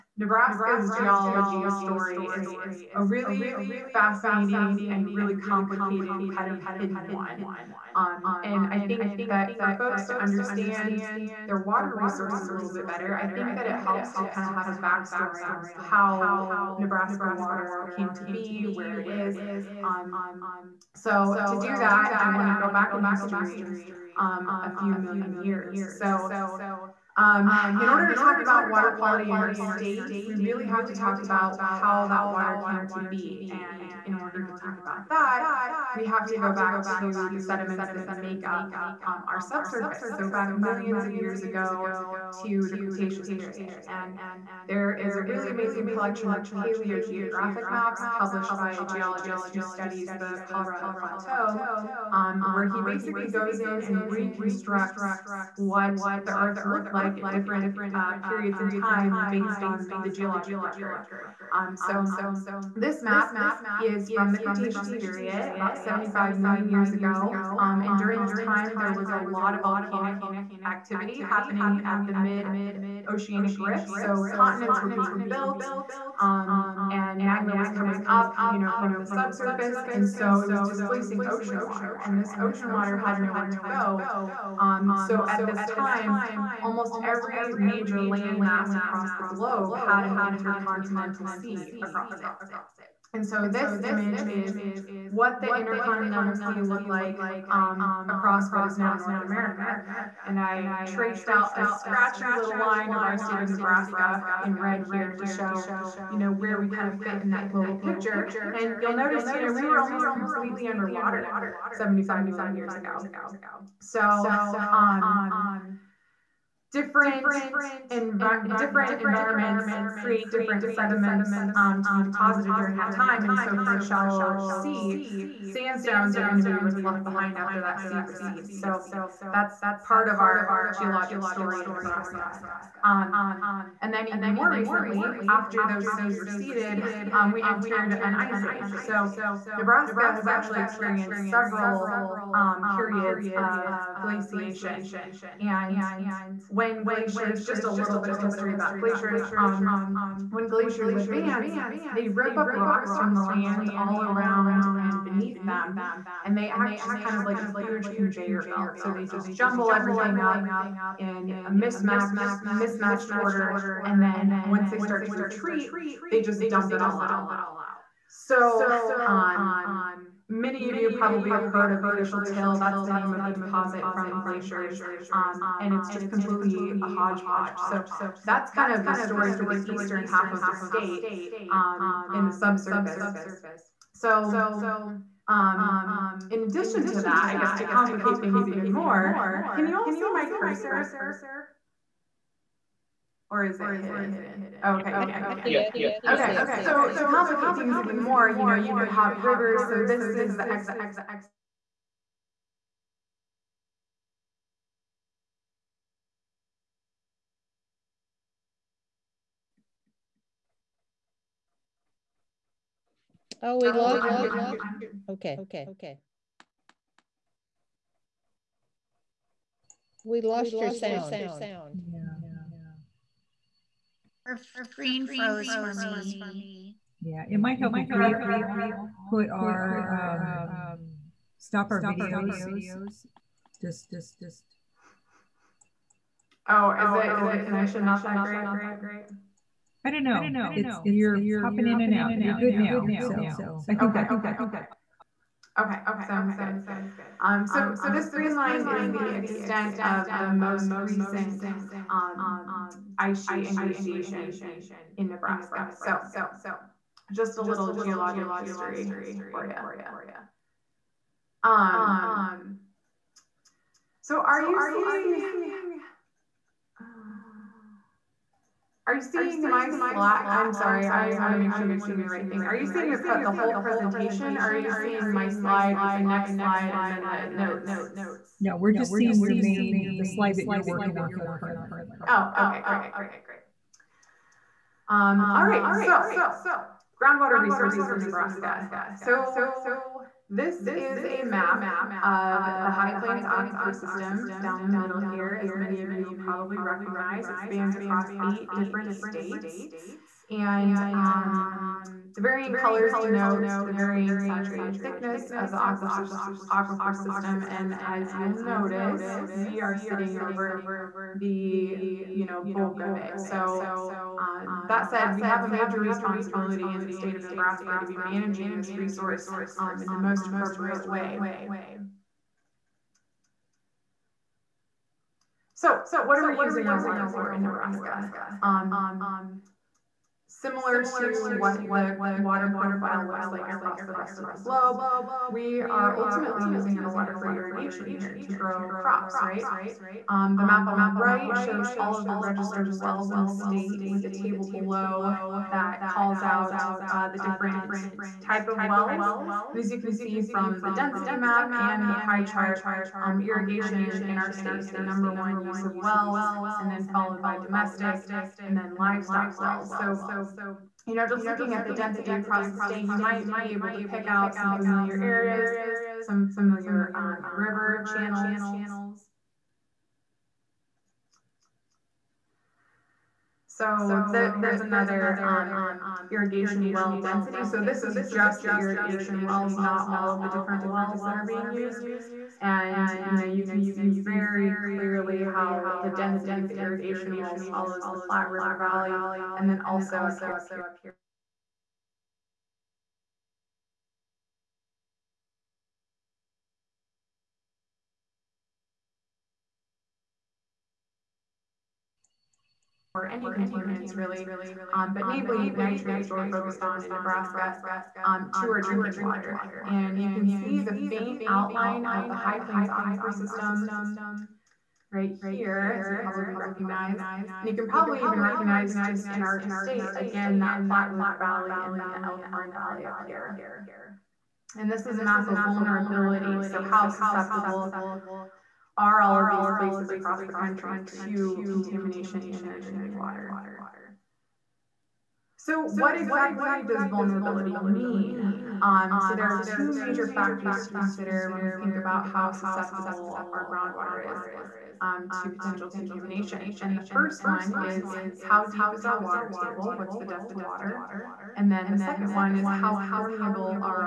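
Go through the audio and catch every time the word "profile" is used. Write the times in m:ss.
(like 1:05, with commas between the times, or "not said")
5:32.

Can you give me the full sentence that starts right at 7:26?
And the first one is how deep is our water table?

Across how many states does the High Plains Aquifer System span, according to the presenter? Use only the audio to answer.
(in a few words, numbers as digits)
8.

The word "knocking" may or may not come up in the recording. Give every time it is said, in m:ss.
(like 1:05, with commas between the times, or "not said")
not said.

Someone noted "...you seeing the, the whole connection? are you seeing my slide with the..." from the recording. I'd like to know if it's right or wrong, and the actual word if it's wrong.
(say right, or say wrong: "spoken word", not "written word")
wrong: "presentation", not "connection".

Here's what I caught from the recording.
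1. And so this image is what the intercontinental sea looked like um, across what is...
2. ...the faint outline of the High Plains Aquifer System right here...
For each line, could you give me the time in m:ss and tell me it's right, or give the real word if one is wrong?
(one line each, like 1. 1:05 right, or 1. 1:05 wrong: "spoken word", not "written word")
1. 1:33 right
2. 6:50 right.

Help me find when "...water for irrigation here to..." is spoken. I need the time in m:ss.
5:36.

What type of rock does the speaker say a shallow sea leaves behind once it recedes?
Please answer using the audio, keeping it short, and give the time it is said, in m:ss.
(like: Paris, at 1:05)
Sandstones, at 2:05.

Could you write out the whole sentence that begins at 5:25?
So what are we using our water for in Nebraska?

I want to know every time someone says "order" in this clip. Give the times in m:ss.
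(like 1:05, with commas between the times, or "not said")
0:27, 0:34, 2:43.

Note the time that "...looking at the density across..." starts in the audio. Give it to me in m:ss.
6:01.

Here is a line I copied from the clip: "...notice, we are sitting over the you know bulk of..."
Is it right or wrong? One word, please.
right.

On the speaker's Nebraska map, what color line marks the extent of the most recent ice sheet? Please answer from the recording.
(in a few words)
Green.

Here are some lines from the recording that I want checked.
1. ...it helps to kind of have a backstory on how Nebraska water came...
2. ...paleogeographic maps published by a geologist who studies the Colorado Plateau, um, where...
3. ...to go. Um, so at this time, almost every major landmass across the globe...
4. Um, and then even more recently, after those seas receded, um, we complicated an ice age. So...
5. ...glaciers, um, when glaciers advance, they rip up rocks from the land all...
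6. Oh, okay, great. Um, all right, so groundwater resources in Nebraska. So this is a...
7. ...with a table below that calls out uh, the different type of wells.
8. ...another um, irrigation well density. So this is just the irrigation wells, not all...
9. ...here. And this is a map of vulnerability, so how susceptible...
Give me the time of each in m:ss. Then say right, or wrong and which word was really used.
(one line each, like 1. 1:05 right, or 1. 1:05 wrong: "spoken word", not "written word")
1. 0:13 right
2. 0:46 right
3. 1:23 right
4. 2:12 wrong: "entered", not "complicated"
5. 2:28 right
6. 4:42 right
7. 5:43 right
8. 6:14 right
9. 7:03 right.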